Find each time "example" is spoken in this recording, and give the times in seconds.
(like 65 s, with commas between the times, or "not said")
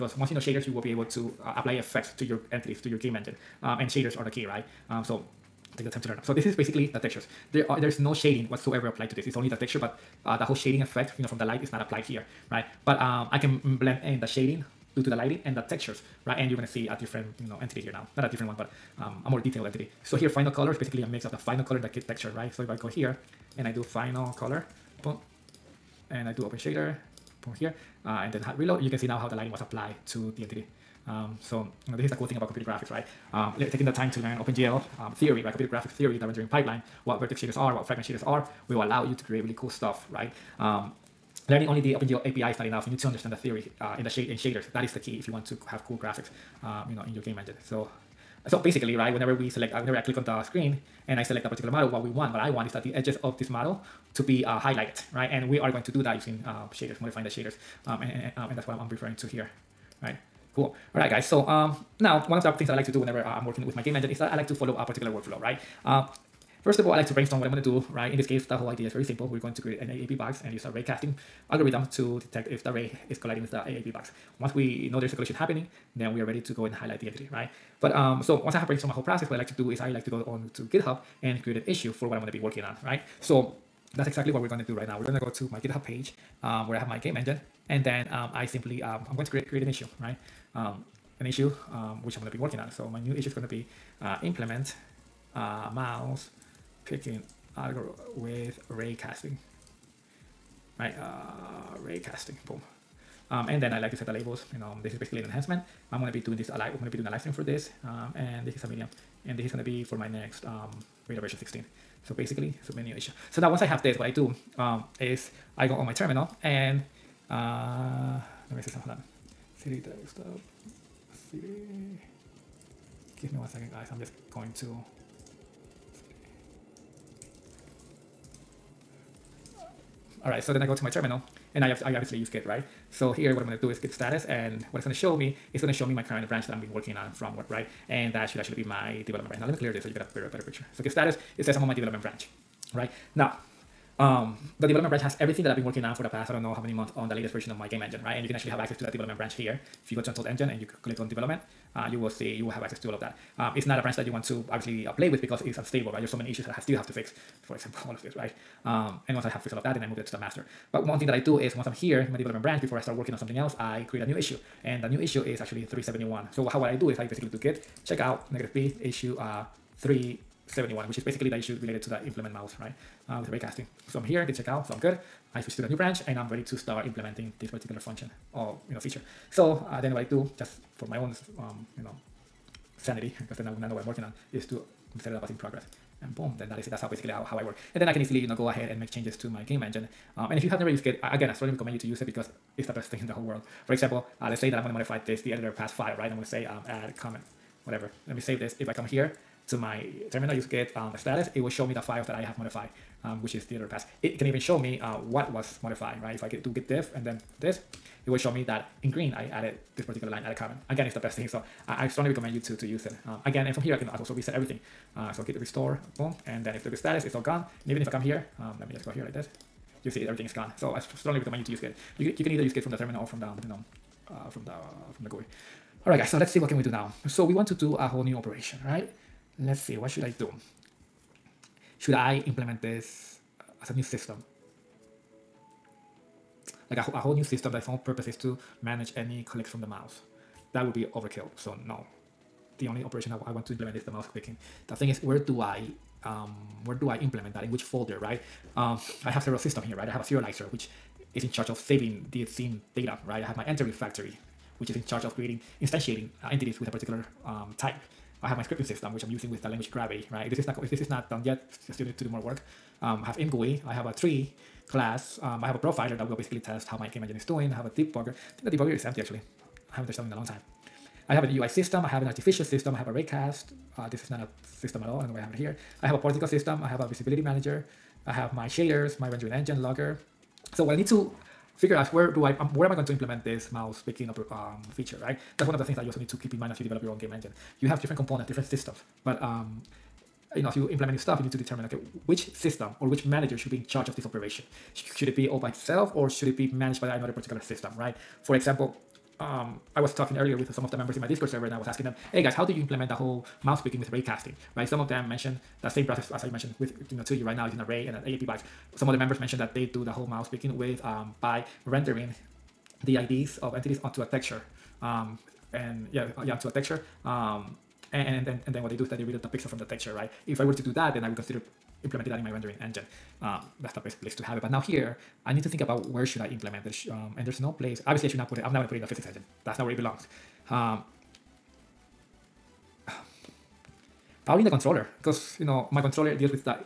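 157 s, 193 s, 298 s.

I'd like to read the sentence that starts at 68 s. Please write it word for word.
In this case, the whole idea is very simple.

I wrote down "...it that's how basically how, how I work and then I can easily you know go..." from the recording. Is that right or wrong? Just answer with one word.
right.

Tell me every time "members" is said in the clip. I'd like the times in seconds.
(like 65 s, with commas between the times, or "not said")
300 s, 308 s.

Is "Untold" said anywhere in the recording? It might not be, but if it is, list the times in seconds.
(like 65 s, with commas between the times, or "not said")
150 s.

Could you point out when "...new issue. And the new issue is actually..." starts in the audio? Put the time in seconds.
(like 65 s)
164 s.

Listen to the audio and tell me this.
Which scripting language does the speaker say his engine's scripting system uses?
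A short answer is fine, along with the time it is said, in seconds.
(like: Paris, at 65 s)
Gravity, at 259 s.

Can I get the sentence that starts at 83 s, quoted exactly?
So that's exactly what we're gonna do right now.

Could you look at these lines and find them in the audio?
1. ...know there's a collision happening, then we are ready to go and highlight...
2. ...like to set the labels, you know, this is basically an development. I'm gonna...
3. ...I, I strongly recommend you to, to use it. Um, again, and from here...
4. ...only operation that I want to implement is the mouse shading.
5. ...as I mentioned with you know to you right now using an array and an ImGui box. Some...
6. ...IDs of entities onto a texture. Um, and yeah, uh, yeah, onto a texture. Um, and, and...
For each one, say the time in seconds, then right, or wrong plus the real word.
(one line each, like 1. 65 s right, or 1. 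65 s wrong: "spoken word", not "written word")
1. 74 s right
2. 103 s wrong: "enhancement", not "development"
3. 211 s right
4. 242 s wrong: "picking", not "shading"
5. 306 s wrong: "AABB", not "ImGui"
6. 312 s right.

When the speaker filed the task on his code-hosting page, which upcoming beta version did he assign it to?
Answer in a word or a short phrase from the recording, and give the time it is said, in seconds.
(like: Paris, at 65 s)
16, at 111 s.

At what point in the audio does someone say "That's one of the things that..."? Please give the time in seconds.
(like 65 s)
285 s.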